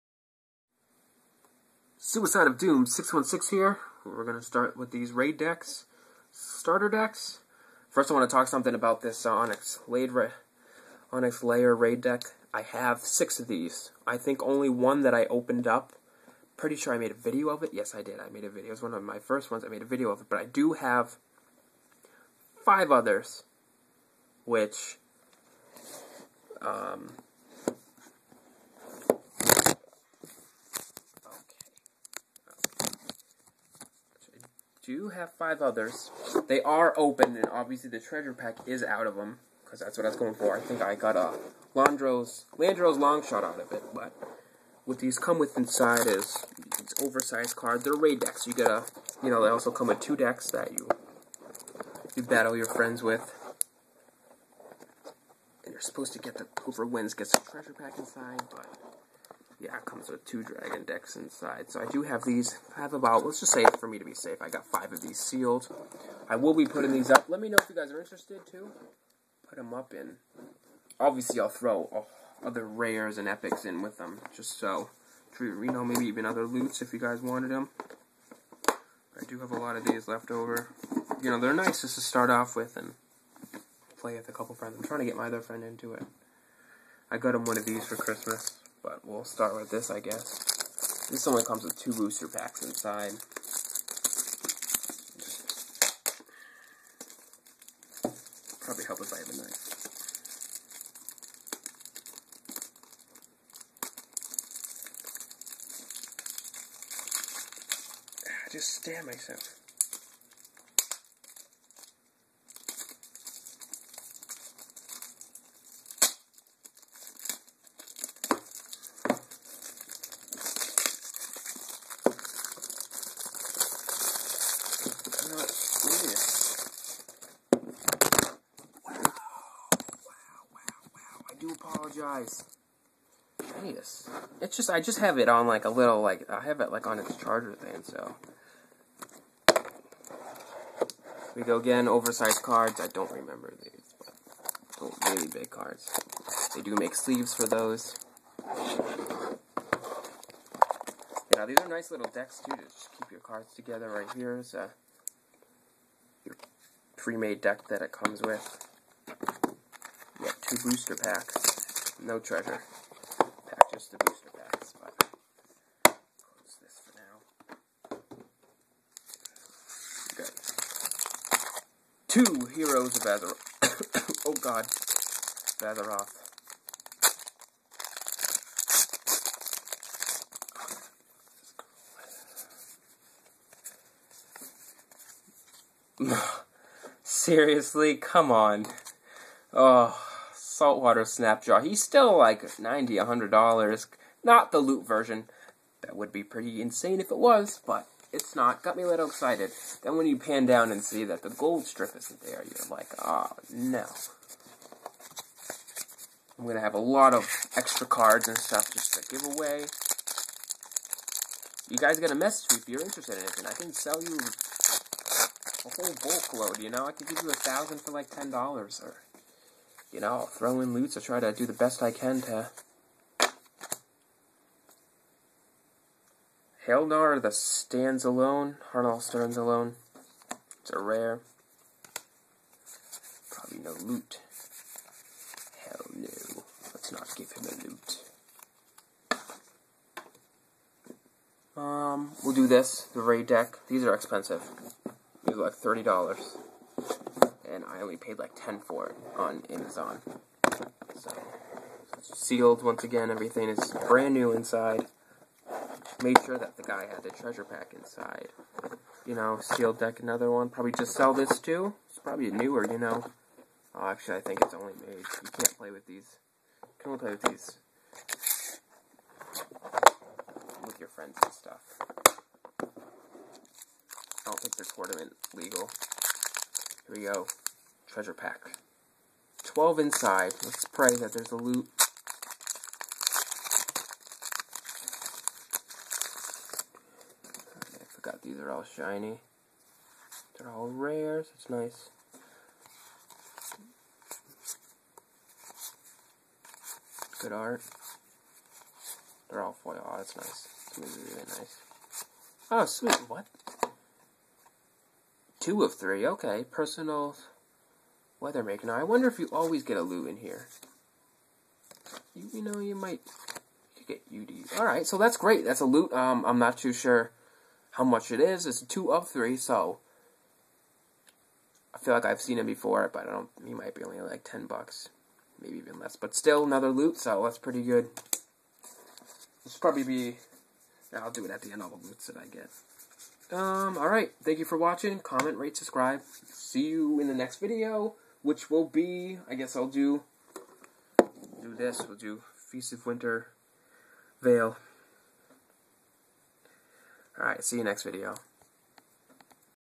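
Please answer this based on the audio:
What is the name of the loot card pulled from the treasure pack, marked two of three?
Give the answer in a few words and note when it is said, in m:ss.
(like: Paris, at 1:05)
Personal Weathermaker, at 5:06.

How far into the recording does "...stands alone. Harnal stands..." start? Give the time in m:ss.
3:47.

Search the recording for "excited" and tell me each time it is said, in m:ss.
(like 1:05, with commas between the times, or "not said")
3:19.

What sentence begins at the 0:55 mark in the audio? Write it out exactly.
And you're supposed to get the whoever wins gets a treasure pack inside, but yeah, it comes with two dragon decks inside.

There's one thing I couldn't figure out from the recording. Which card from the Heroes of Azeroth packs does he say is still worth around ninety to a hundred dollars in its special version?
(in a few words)
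Saltwater Snapjaw.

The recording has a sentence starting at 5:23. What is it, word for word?
He might be only like 10 bucks.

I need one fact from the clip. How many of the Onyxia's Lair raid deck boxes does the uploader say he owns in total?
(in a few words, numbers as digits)
6.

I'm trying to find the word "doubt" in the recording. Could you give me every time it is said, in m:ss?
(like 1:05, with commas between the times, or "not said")
not said.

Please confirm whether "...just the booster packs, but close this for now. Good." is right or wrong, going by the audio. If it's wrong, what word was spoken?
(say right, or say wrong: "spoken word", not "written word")
right.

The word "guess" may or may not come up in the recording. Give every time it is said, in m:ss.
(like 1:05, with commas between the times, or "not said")
1:29, 5:39.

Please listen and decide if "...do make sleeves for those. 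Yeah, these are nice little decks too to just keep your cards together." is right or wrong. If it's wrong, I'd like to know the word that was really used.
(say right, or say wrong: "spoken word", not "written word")
right.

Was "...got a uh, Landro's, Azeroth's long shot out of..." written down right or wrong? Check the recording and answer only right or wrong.
wrong.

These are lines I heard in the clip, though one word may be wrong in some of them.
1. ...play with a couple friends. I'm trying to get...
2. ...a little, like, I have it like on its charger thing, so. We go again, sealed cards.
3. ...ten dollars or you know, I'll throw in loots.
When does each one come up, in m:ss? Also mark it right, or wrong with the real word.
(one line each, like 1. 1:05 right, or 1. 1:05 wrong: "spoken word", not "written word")
1. 1:23 right
2. 2:15 wrong: "oversized", not "sealed"
3. 3:38 right.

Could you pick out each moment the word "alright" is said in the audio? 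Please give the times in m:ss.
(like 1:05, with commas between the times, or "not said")
5:14, 5:33, 5:47.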